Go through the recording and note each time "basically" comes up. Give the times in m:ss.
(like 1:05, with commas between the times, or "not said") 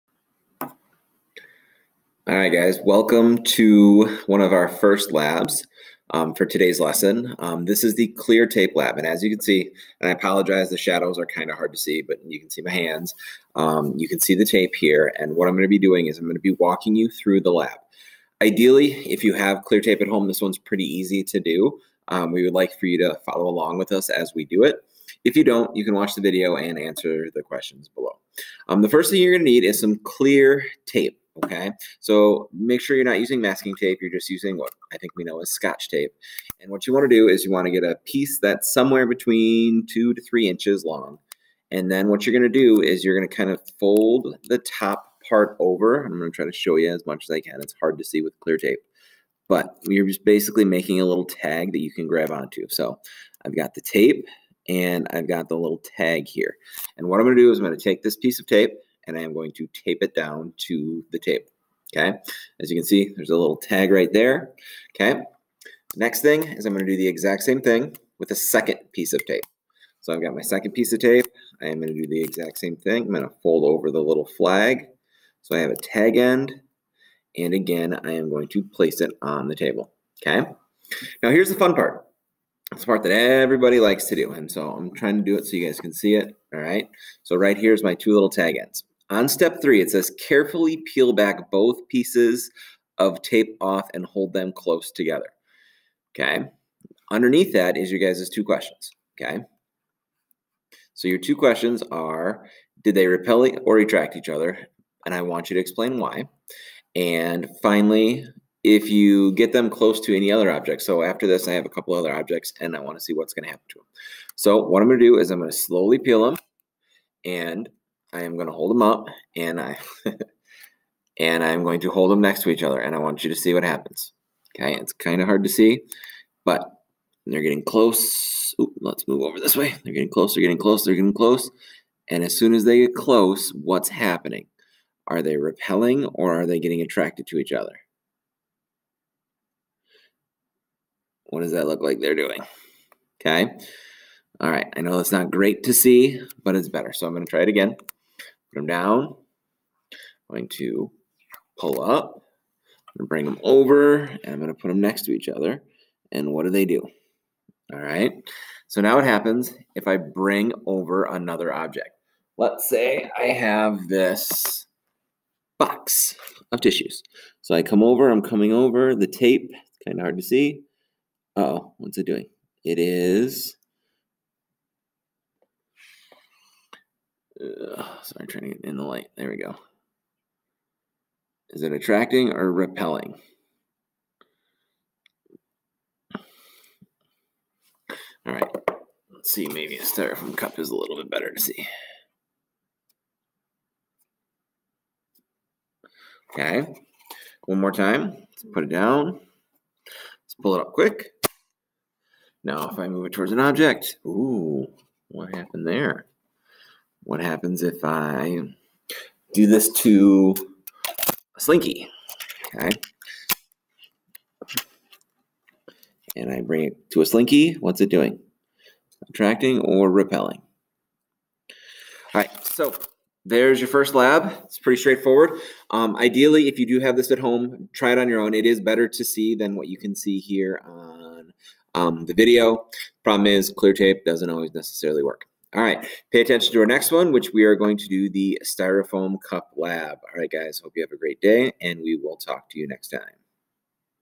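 0:50.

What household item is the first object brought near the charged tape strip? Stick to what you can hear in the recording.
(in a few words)
box of tissues.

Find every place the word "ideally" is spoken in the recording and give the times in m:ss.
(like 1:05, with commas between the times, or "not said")
0:18, 3:45.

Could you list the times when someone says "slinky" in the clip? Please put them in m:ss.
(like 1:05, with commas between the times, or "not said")
3:31, 3:37.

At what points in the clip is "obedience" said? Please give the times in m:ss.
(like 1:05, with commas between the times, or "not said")
not said.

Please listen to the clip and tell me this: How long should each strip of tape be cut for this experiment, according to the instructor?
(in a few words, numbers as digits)
2 to 3 inches.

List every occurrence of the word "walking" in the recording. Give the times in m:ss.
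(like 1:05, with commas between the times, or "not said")
0:16.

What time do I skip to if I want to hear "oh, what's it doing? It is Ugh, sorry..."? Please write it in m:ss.
2:51.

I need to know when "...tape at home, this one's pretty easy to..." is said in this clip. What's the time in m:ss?
0:19.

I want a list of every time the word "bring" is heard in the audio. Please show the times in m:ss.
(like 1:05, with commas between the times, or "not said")
2:33, 2:39, 3:36.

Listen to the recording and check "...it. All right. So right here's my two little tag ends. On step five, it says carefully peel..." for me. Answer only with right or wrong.
wrong.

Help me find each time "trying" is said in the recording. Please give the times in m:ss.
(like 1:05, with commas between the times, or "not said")
1:24, 2:58.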